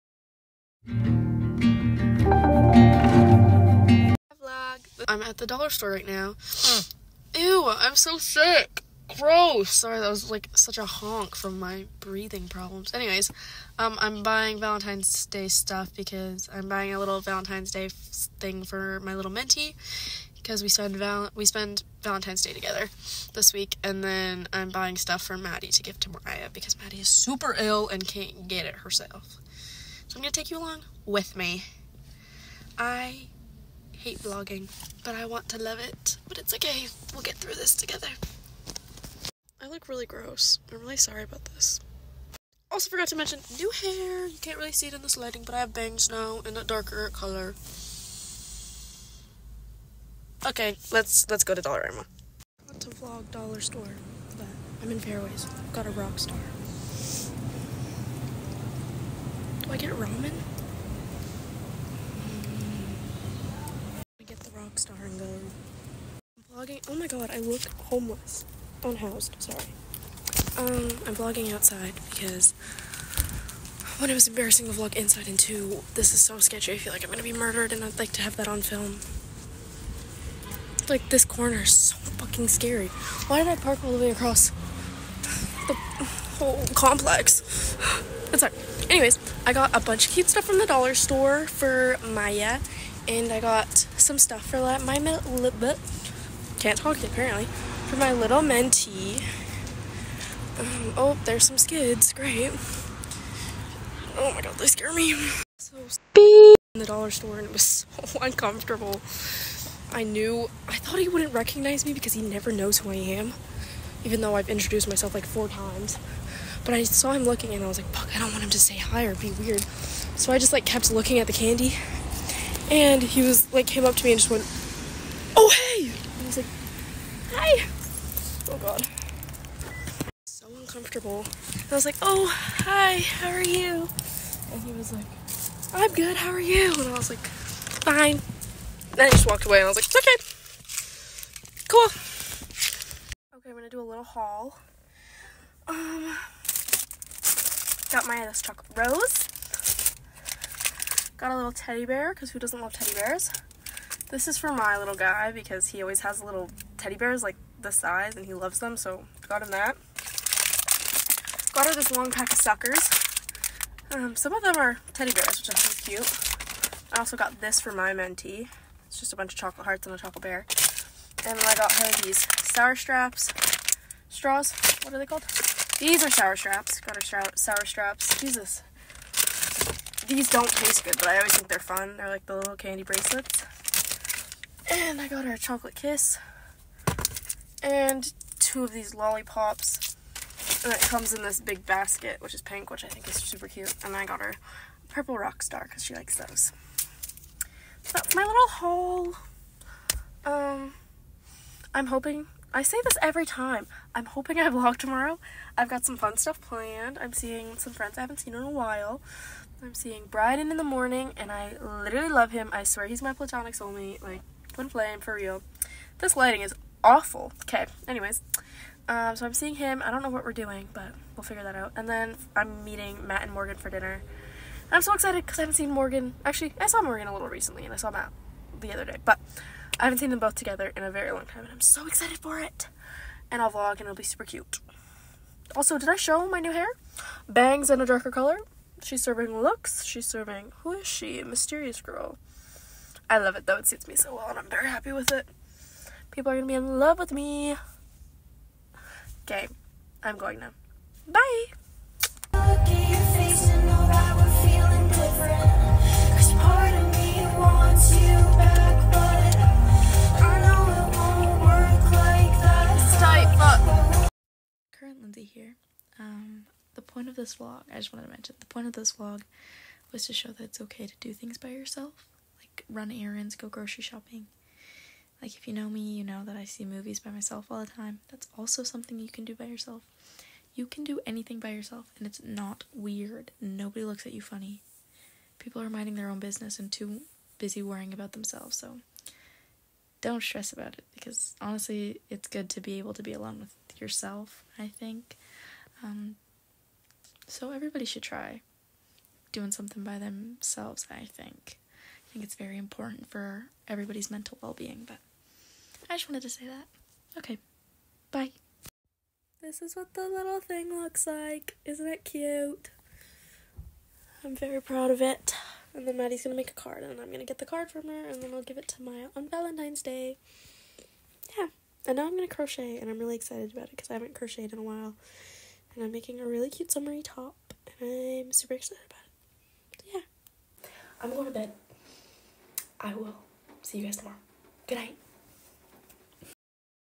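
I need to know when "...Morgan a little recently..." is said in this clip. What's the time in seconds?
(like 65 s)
226 s.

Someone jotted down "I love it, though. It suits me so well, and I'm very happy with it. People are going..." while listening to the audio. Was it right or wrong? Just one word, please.
right.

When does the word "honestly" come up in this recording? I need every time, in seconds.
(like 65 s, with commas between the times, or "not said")
291 s.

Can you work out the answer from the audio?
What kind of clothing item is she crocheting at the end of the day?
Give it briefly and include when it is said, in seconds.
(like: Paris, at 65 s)
summery top, at 326 s.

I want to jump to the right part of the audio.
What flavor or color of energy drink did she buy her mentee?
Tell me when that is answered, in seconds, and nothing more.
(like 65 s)
194 s.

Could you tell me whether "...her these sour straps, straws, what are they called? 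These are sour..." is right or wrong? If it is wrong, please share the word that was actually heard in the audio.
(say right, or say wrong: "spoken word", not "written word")
right.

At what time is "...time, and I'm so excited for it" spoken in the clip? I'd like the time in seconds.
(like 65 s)
231 s.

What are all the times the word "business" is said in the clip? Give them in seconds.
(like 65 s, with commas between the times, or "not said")
286 s.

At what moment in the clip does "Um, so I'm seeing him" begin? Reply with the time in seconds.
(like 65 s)
218 s.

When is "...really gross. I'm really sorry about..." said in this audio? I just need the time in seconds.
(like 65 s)
39 s.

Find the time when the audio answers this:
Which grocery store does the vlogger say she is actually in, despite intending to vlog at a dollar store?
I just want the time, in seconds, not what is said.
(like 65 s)
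54 s.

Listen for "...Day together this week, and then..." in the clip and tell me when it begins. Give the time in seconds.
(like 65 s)
22 s.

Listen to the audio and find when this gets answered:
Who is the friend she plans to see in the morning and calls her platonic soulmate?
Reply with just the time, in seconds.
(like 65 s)
210 s.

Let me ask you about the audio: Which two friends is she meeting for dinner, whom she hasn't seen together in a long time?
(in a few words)
Matt and Morgan.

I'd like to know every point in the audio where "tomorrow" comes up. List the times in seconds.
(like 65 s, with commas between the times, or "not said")
204 s, 333 s.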